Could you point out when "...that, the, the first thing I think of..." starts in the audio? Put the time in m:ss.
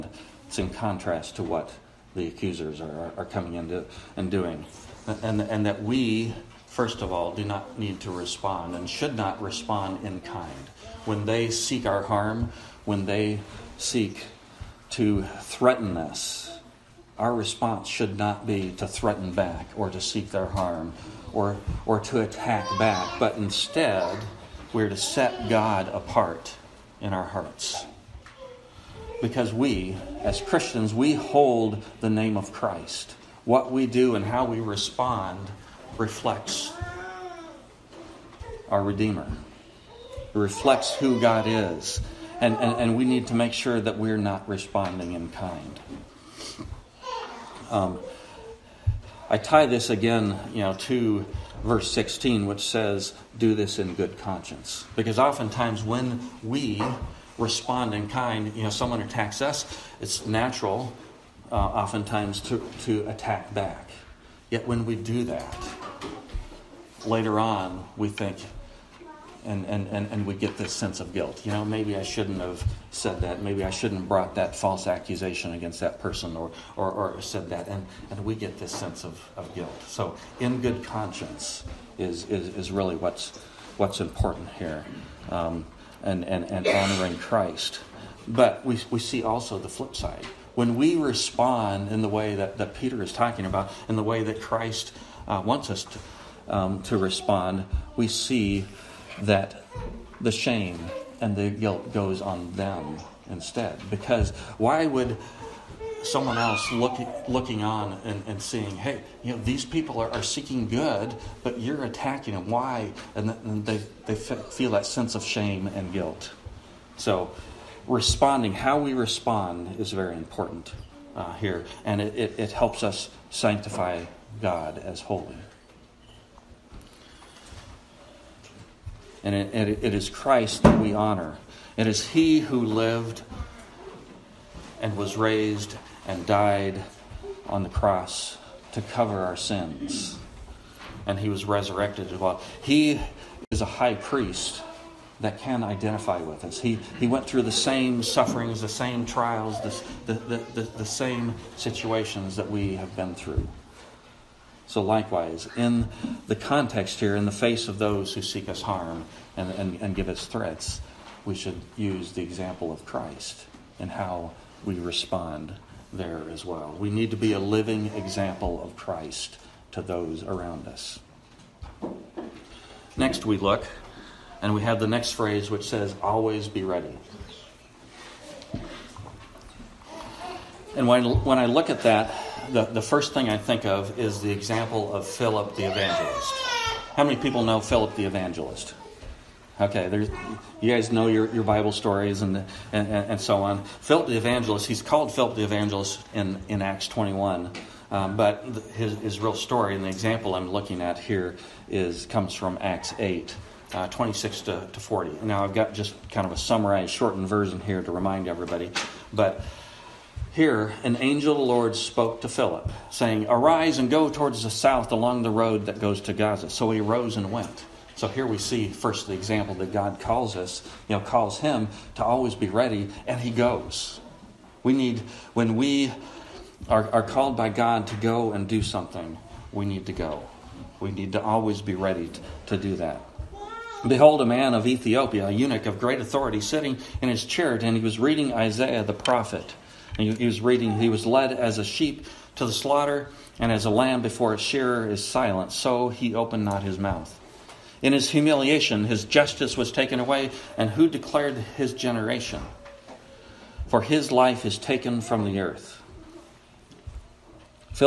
3:01.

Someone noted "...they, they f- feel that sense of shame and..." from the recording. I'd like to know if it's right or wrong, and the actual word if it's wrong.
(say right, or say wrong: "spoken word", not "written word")
right.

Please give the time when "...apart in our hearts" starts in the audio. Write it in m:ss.
0:25.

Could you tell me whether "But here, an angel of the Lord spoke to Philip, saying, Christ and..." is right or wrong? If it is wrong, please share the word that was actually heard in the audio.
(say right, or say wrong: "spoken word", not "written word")
wrong: "Arise", not "Christ".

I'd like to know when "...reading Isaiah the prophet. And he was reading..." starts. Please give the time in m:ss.
3:57.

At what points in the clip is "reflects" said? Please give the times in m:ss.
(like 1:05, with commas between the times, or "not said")
0:35, 0:40.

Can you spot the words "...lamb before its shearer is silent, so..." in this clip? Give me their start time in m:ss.
4:03.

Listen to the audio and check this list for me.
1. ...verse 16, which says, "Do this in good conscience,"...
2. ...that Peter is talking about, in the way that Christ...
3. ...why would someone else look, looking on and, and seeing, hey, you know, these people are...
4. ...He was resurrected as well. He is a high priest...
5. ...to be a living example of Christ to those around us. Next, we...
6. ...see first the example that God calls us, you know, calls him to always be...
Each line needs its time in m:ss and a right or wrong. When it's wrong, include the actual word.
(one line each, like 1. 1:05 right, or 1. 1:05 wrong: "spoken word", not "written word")
1. 0:51 right
2. 1:32 right
3. 1:44 right
4. 2:21 right
5. 2:47 right
6. 3:38 right.